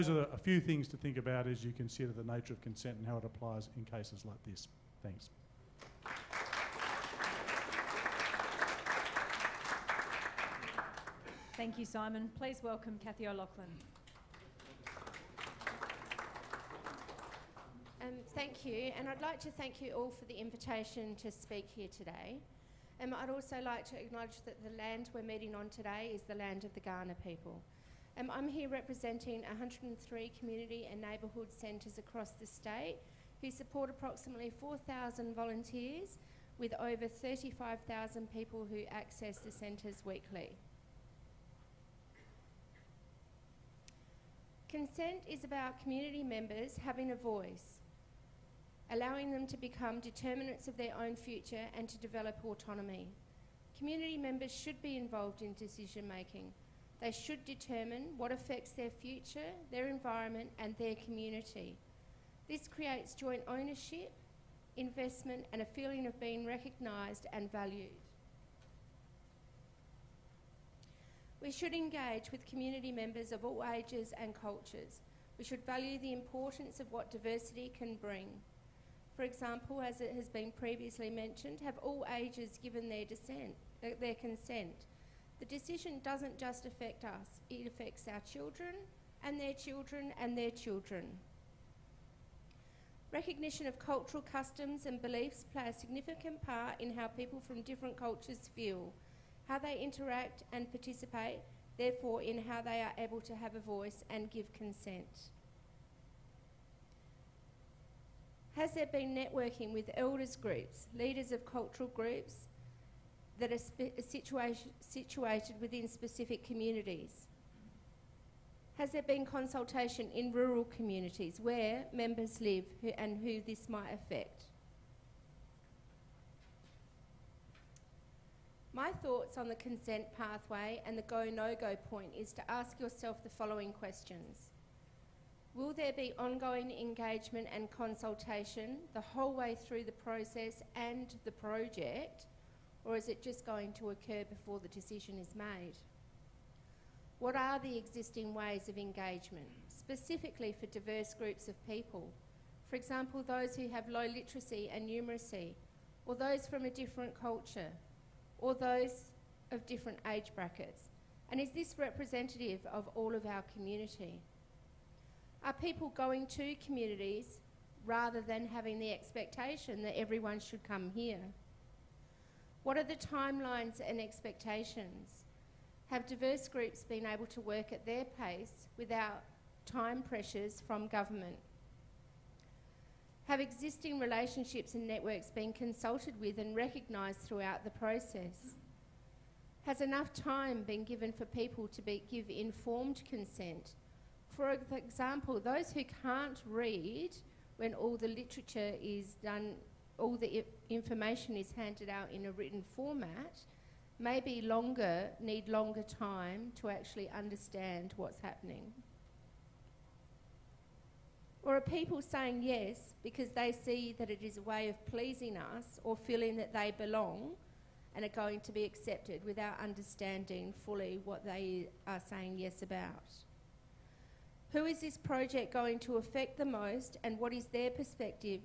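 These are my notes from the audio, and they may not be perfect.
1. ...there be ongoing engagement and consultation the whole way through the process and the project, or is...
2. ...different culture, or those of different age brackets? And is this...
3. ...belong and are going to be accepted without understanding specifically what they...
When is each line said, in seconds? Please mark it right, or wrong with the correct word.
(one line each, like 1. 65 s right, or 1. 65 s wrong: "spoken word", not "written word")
1. 135 s right
2. 156 s right
3. 216 s wrong: "fully", not "specifically".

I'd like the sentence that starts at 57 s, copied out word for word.
They should determine what affects their future, their environment, and their community.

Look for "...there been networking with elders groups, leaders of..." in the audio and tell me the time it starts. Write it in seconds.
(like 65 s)
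108 s.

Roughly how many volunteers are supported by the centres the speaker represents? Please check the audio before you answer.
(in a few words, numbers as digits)
4,000.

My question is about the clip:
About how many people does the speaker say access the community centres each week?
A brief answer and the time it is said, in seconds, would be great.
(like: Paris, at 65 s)
35,000, at 37 s.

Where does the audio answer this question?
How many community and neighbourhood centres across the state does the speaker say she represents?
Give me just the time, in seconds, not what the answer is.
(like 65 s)
29 s.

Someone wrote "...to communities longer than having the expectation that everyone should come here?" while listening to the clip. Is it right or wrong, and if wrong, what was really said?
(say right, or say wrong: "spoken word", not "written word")
wrong: "rather", not "longer".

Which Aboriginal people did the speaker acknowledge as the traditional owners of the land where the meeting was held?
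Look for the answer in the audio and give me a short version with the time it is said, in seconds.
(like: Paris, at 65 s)
Kaurna, at 26 s.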